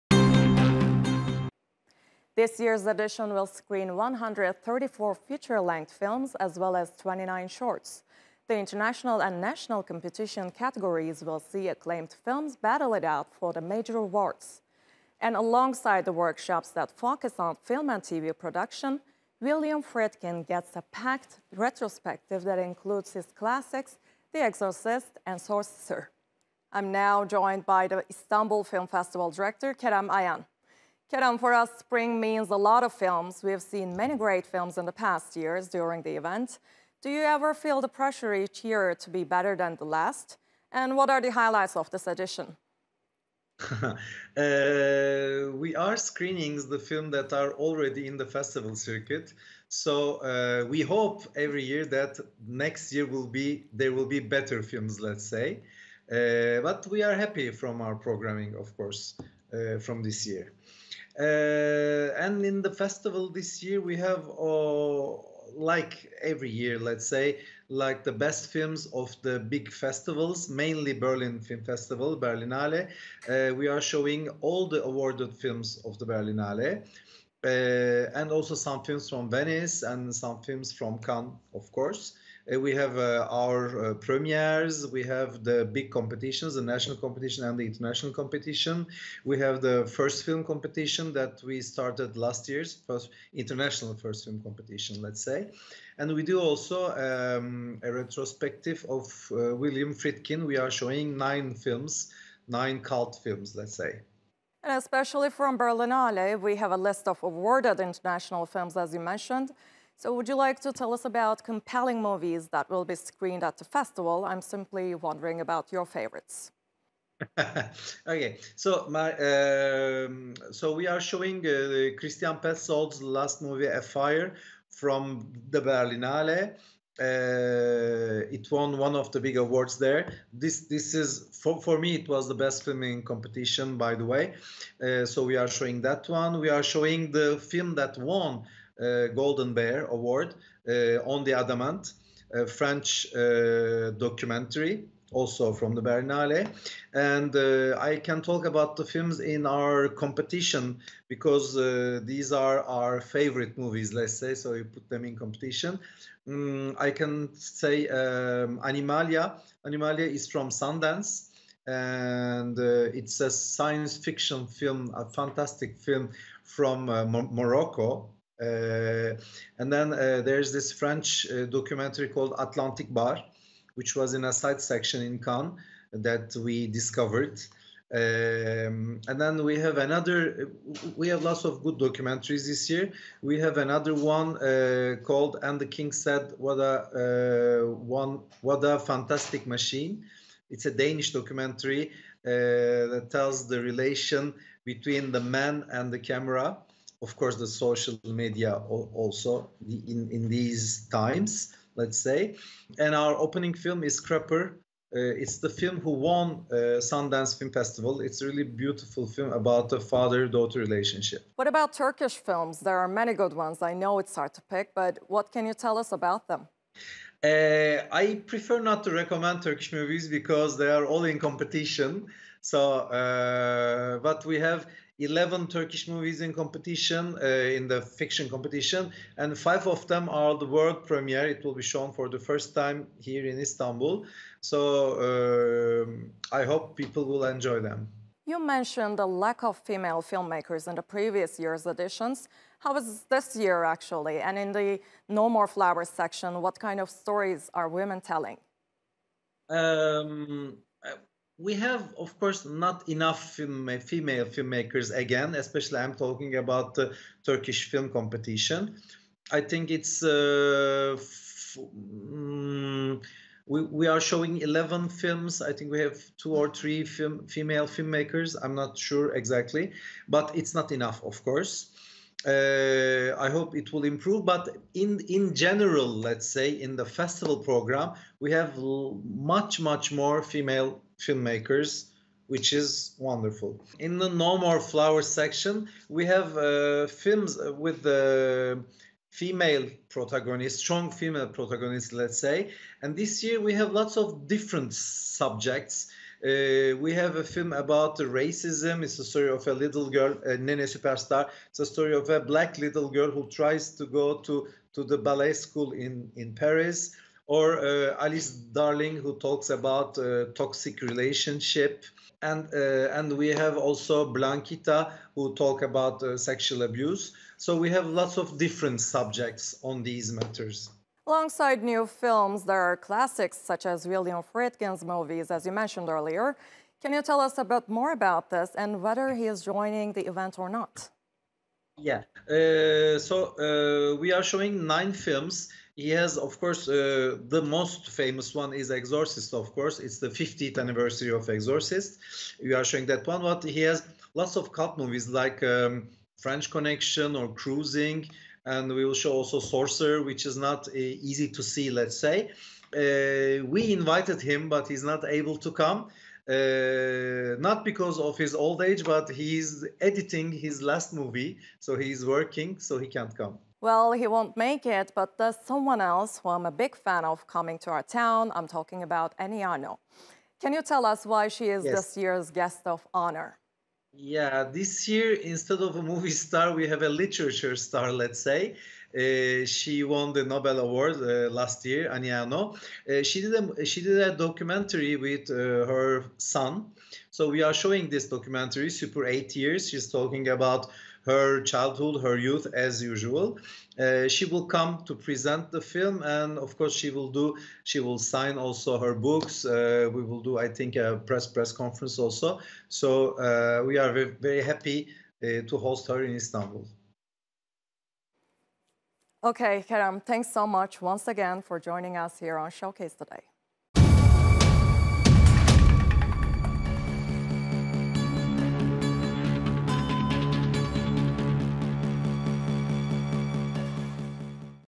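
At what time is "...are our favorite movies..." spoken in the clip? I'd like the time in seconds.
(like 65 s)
152 s.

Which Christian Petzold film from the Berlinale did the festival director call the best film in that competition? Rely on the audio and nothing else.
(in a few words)
Afire.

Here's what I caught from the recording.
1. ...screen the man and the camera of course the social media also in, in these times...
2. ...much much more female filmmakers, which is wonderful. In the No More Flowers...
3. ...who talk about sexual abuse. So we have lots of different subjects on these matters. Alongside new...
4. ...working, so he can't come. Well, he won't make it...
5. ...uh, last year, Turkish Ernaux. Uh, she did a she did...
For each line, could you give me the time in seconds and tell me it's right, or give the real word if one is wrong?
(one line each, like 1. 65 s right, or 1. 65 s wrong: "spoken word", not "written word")
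1. 194 s wrong: "between", not "screen"
2. 278 s right
3. 315 s right
4. 362 s right
5. 380 s wrong: "Annie", not "Turkish".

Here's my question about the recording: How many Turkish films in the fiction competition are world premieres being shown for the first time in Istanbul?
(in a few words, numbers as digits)
5.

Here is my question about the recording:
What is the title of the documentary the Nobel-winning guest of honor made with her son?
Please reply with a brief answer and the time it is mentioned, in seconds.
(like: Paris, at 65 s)
Super Eight Years, at 388 s.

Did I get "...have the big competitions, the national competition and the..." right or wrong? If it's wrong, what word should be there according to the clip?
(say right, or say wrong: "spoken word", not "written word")
right.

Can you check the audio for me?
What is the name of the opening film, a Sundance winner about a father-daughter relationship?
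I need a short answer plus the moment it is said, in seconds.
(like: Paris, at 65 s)
Scrapper, at 203 s.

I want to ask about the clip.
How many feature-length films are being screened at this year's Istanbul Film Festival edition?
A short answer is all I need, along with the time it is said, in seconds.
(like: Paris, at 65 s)
134, at 3 s.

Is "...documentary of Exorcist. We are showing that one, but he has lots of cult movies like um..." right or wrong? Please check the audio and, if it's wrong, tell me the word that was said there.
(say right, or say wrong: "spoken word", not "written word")
wrong: "anniversary", not "documentary".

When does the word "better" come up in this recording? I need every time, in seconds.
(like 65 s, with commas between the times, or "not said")
39 s, 54 s.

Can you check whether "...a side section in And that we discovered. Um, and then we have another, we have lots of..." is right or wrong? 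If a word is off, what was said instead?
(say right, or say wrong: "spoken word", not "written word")
wrong: "Cannes", not "And".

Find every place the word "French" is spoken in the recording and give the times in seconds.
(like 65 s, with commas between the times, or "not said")
142 s, 170 s, 346 s.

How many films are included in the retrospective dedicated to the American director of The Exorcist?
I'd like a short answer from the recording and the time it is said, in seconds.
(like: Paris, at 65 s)
9, at 101 s.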